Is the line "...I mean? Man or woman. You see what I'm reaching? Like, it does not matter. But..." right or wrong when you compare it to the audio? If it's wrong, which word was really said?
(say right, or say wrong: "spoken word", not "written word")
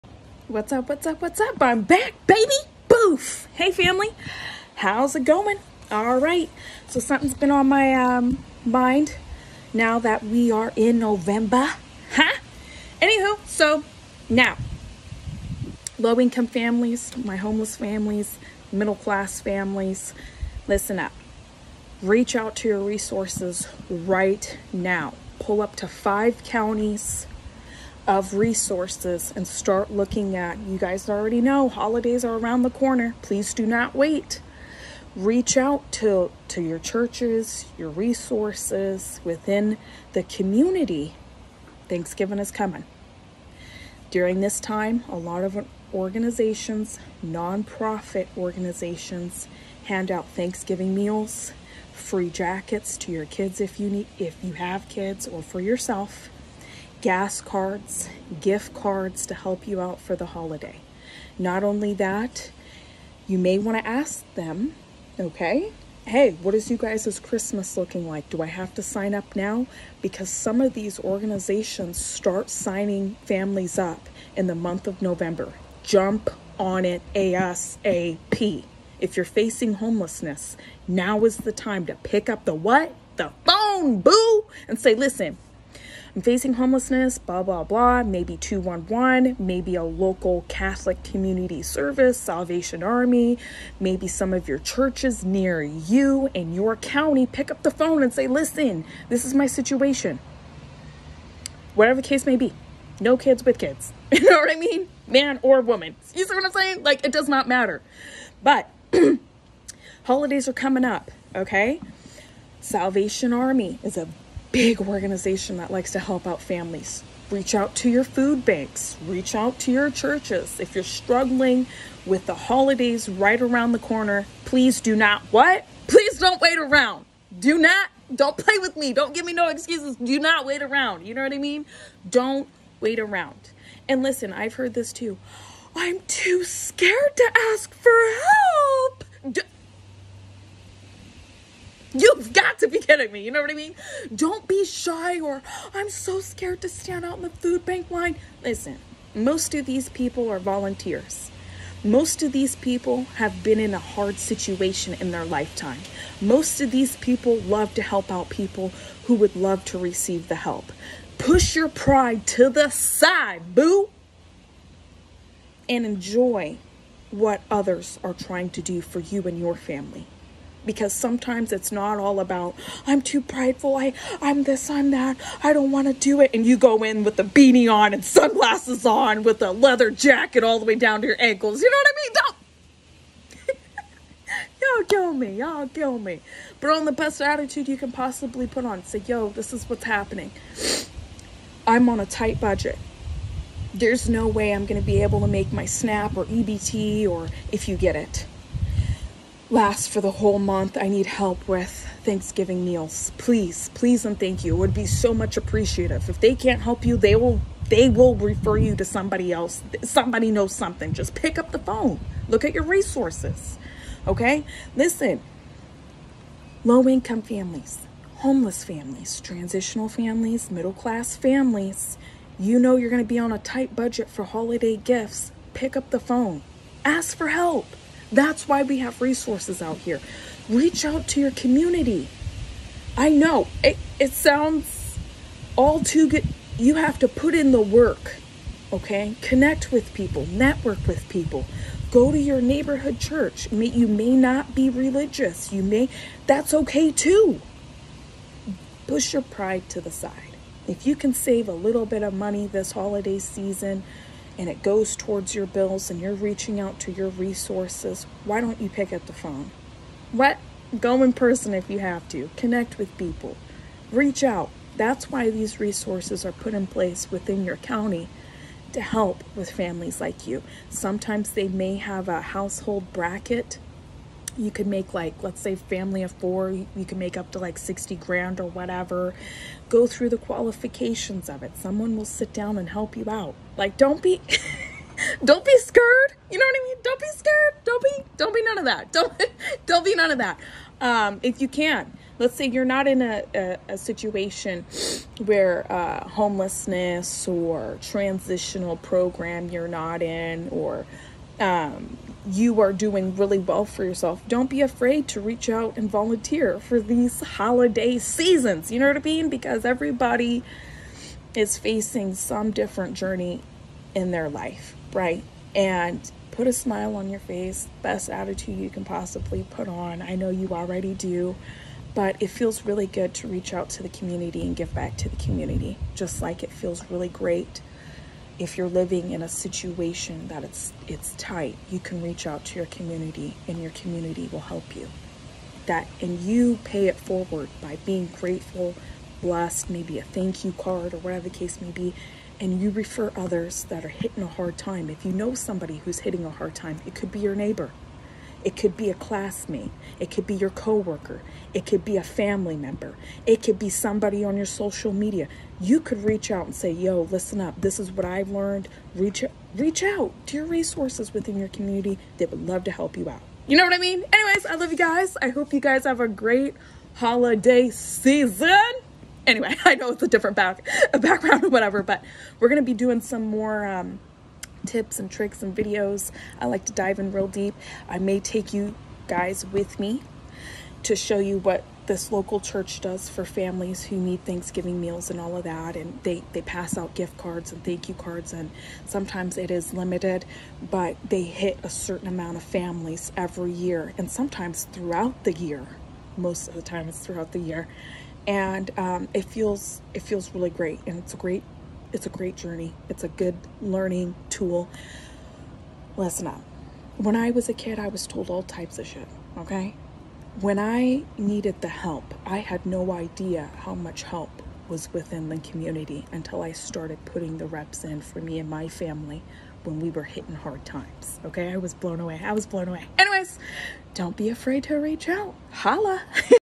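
wrong: "saying", not "reaching".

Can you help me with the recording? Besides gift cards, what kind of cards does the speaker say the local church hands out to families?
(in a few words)
thank you cards.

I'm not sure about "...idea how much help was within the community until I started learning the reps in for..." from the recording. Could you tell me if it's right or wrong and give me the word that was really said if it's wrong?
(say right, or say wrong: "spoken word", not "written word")
wrong: "putting", not "learning".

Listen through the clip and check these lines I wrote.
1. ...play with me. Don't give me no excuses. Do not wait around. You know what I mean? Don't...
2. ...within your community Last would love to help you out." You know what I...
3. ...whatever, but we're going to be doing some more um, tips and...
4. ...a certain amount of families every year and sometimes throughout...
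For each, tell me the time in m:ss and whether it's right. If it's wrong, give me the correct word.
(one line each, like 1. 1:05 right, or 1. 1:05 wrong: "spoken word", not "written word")
1. 2:08 right
2. 6:01 wrong: "They", not "Last"
3. 6:11 right
4. 6:31 right.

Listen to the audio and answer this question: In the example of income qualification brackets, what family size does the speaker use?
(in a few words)
4.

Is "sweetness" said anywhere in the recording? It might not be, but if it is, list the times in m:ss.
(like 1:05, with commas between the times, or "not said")
not said.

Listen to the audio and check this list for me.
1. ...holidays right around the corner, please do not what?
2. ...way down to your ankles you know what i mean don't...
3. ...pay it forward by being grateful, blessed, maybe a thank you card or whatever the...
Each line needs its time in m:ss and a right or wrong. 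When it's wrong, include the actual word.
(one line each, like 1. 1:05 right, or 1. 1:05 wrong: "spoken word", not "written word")
1. 2:02 right
2. 3:00 right
3. 5:36 right.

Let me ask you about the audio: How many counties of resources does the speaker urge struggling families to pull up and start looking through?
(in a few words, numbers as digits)
5.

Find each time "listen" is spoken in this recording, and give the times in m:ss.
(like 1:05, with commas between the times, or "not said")
0:20, 1:24, 1:38, 2:14, 2:28, 3:34, 5:57, 6:45.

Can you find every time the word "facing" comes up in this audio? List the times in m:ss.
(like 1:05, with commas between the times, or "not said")
1:19, 1:26, 5:11.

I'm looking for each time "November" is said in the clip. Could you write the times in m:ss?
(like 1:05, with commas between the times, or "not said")
0:10, 1:15.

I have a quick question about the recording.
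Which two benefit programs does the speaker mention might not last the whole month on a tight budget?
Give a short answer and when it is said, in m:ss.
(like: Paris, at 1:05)
SNAP or EBT, at 3:15.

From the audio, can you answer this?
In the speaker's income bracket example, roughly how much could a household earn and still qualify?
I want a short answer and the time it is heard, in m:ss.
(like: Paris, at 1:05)
60 grand, at 4:37.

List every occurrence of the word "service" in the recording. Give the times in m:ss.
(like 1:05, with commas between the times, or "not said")
1:31.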